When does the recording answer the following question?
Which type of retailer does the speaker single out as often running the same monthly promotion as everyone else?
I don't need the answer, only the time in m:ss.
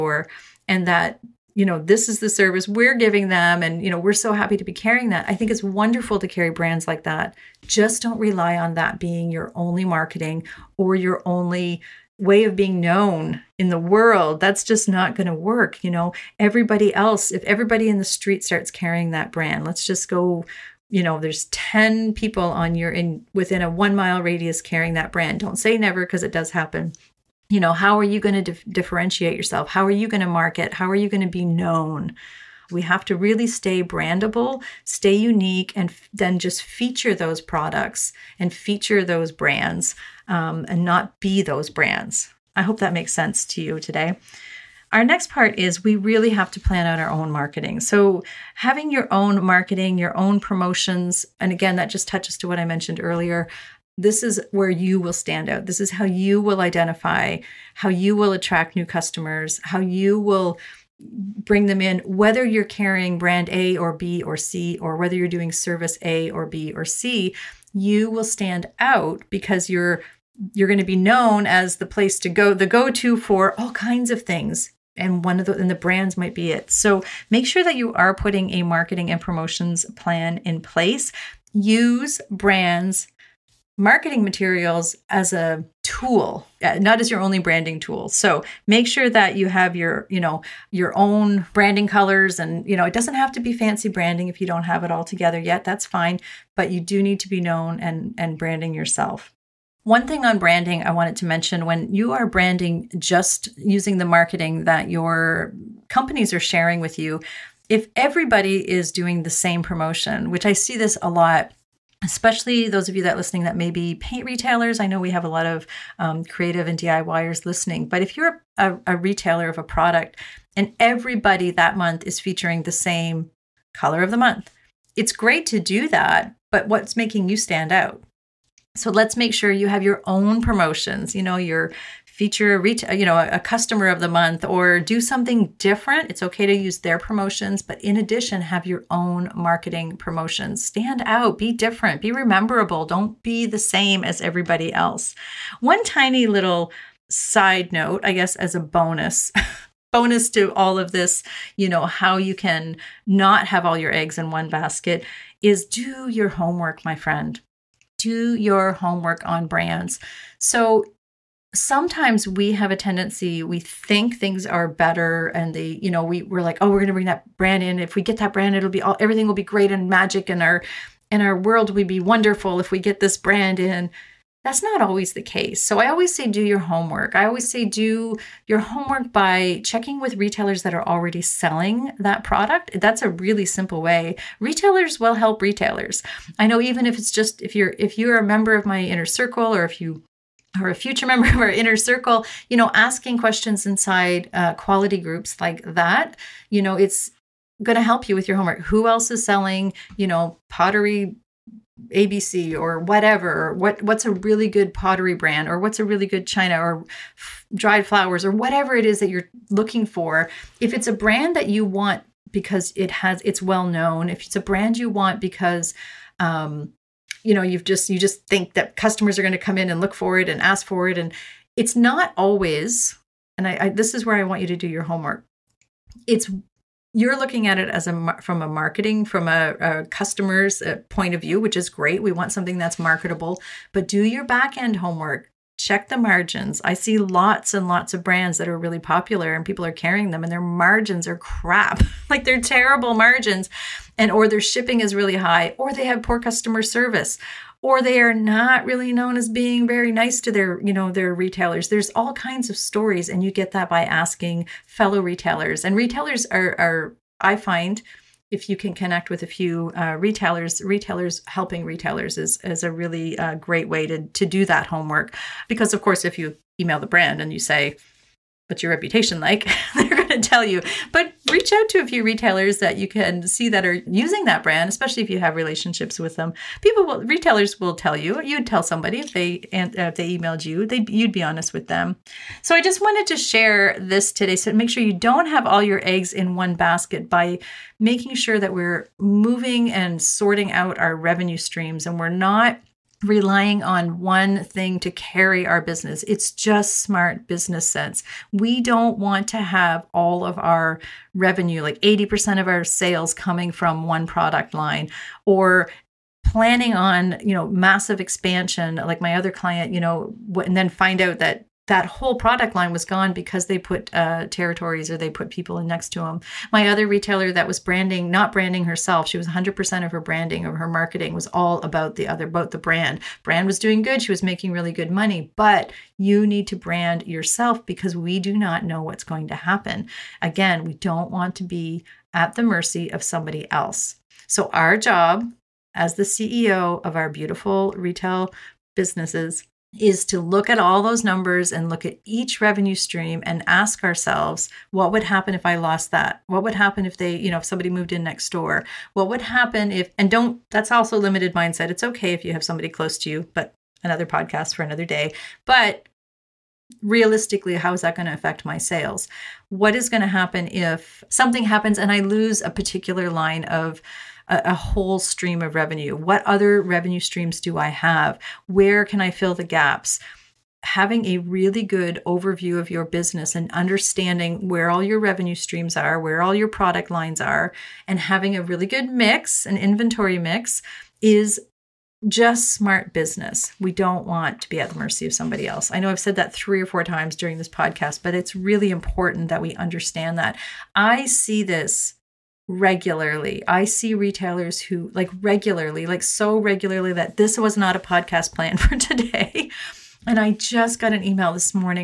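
1:53.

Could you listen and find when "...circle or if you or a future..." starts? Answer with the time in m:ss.
3:09.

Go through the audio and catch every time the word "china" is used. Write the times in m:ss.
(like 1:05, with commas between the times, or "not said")
3:26.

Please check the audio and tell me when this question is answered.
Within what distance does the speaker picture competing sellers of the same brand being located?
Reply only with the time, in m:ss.
0:23.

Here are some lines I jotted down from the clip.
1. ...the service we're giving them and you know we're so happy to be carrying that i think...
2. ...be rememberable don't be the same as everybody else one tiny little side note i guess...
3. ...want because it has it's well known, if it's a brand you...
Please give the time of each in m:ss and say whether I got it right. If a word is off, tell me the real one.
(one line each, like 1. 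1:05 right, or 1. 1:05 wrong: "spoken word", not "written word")
1. 0:02 right
2. 2:22 right
3. 3:31 right.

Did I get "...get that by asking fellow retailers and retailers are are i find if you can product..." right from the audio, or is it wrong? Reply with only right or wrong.
wrong.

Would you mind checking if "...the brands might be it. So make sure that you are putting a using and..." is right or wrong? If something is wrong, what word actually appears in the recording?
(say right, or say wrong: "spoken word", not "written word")
wrong: "marketing", not "using".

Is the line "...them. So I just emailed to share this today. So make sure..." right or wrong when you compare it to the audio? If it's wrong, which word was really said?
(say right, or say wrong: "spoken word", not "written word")
wrong: "wanted", not "emailed".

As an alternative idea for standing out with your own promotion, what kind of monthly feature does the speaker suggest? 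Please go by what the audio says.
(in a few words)
customer of the month.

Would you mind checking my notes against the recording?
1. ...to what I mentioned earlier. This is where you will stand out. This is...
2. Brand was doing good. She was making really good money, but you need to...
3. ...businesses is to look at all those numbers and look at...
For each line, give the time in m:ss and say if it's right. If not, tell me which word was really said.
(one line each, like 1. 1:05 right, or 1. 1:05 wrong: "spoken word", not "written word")
1. 0:52 right
2. 5:23 right
3. 5:38 right.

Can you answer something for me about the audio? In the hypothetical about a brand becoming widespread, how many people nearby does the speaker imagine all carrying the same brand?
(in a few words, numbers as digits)
10.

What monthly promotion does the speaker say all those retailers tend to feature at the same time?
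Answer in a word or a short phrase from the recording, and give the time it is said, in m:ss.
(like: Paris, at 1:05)
color of the month, at 2:03.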